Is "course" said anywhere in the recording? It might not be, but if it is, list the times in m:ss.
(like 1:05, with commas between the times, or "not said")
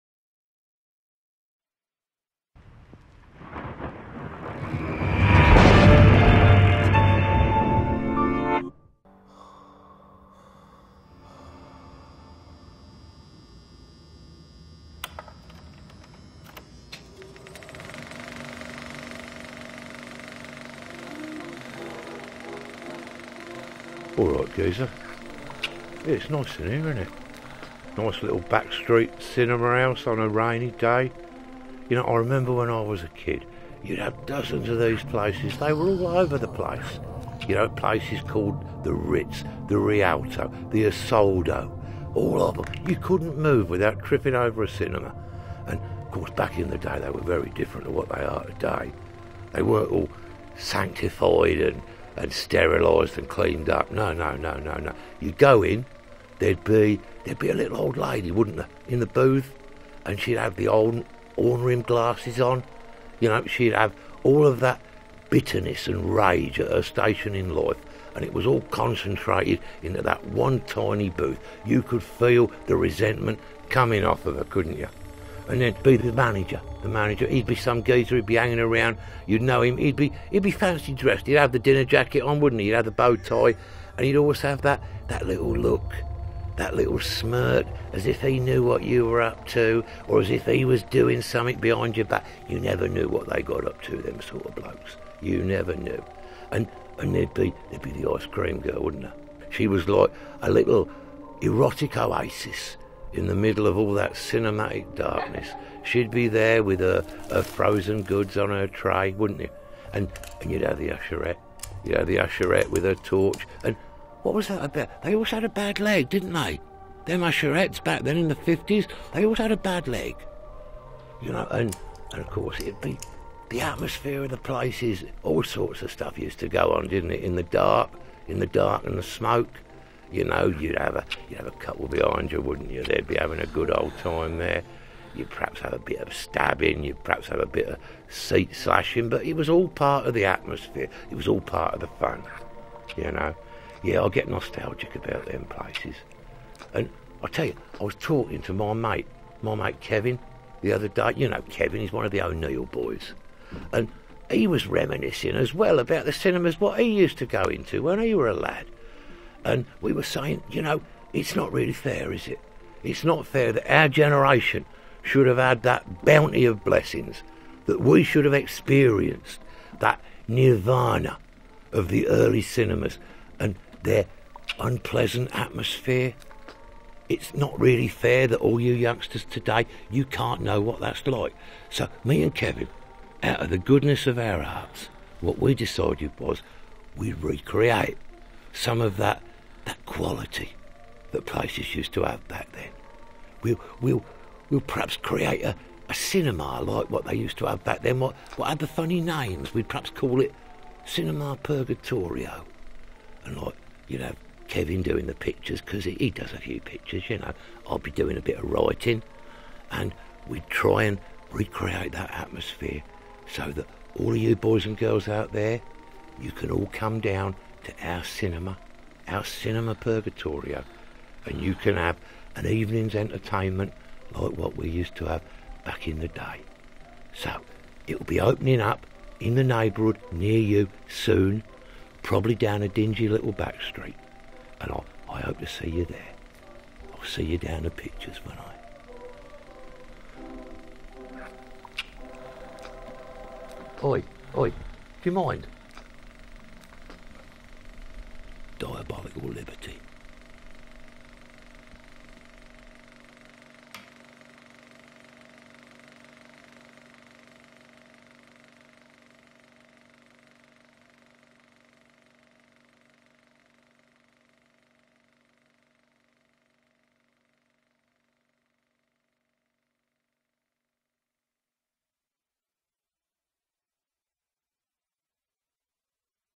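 0:46, 2:02.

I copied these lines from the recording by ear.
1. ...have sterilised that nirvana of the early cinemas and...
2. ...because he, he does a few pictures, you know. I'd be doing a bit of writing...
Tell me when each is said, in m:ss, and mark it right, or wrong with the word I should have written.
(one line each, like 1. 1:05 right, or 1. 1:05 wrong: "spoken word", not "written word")
1. 2:48 wrong: "experienced", not "sterilised"
2. 3:25 right.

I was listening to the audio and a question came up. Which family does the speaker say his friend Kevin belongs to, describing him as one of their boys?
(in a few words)
O'Neill.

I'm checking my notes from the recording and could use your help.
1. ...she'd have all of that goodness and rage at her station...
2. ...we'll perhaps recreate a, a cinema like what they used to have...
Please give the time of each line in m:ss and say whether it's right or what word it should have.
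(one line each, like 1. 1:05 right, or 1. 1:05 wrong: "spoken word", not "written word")
1. 1:03 wrong: "bitterness", not "goodness"
2. 3:14 wrong: "create", not "recreate".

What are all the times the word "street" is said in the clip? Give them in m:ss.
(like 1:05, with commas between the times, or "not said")
0:28, 3:53.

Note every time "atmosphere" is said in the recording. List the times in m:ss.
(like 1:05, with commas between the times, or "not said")
2:03, 2:20, 2:55, 3:32.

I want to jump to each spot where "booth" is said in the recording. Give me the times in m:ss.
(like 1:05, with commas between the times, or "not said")
0:59, 1:11.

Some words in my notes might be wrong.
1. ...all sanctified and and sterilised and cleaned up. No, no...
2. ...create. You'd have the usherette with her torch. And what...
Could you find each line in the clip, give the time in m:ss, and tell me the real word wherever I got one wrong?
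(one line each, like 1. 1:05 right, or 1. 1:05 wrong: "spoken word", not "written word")
1. 0:49 right
2. 1:50 wrong: "usherette", not "create".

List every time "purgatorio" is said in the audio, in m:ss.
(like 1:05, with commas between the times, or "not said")
3:21, 3:39.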